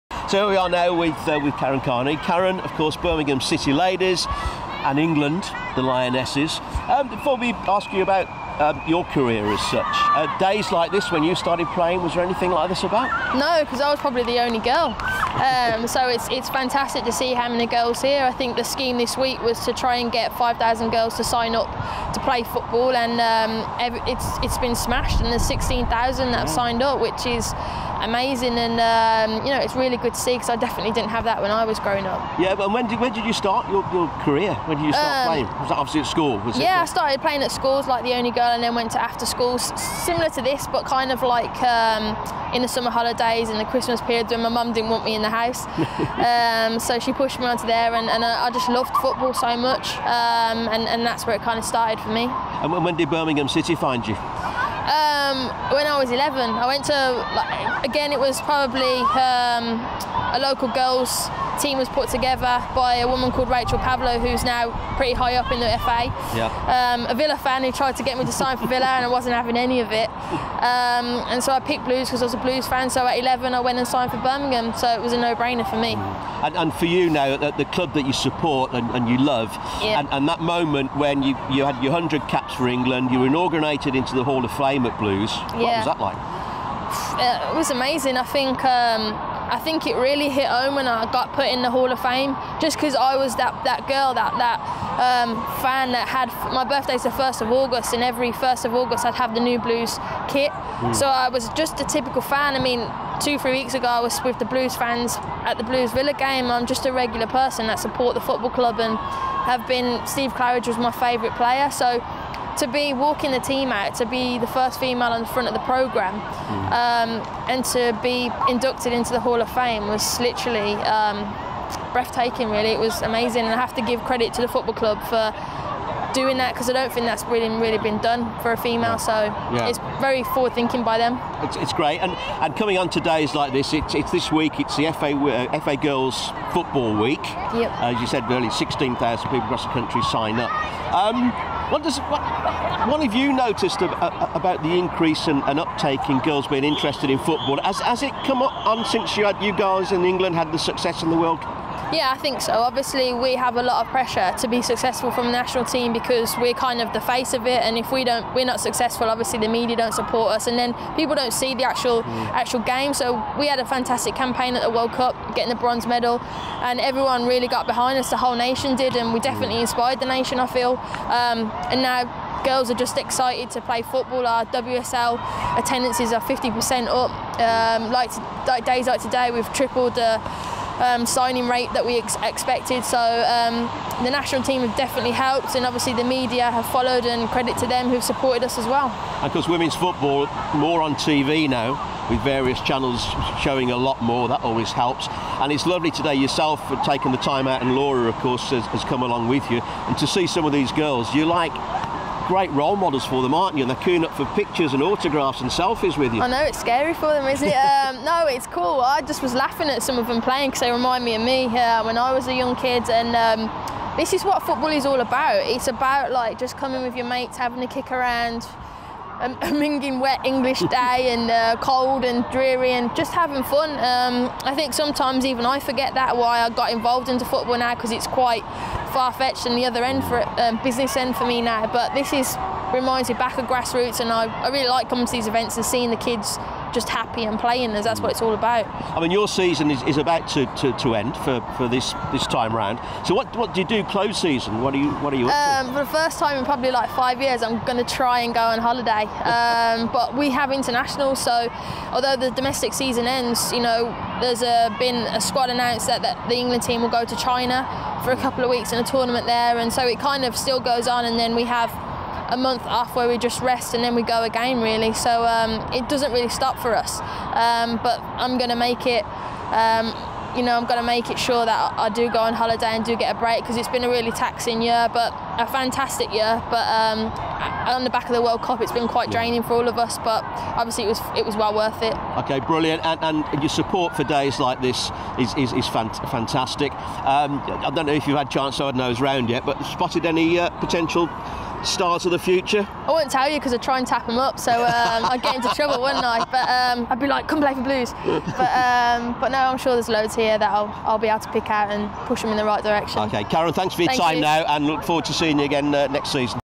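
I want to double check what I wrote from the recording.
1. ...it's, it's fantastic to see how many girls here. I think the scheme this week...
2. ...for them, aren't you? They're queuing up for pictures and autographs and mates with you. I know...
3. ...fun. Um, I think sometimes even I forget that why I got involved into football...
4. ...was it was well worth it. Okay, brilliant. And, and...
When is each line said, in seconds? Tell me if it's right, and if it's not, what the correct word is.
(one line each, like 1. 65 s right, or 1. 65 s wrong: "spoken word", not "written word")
1. 16 s right
2. 203 s wrong: "selfies", not "mates"
3. 223 s right
4. 280 s right.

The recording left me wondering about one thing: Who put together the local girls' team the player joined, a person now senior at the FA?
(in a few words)
Rachel Pavlou.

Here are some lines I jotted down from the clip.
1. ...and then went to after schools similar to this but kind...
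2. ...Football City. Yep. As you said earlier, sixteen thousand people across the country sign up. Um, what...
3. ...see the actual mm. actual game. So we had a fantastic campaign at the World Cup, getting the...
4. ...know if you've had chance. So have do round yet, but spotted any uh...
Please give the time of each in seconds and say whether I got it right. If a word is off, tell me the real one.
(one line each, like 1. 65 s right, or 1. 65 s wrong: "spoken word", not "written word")
1. 38 s right
2. 136 s wrong: "Week", not "City"
3. 161 s right
4. 287 s right.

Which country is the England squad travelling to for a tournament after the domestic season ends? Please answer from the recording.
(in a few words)
China.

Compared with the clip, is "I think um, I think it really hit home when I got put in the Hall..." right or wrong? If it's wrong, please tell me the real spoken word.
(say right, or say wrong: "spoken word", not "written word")
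right.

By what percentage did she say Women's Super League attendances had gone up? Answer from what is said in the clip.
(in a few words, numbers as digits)
50%.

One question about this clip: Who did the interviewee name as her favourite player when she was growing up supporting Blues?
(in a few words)
Steve Claridge.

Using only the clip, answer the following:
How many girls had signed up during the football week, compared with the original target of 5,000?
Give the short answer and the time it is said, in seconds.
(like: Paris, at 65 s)
16,000, at 25 s.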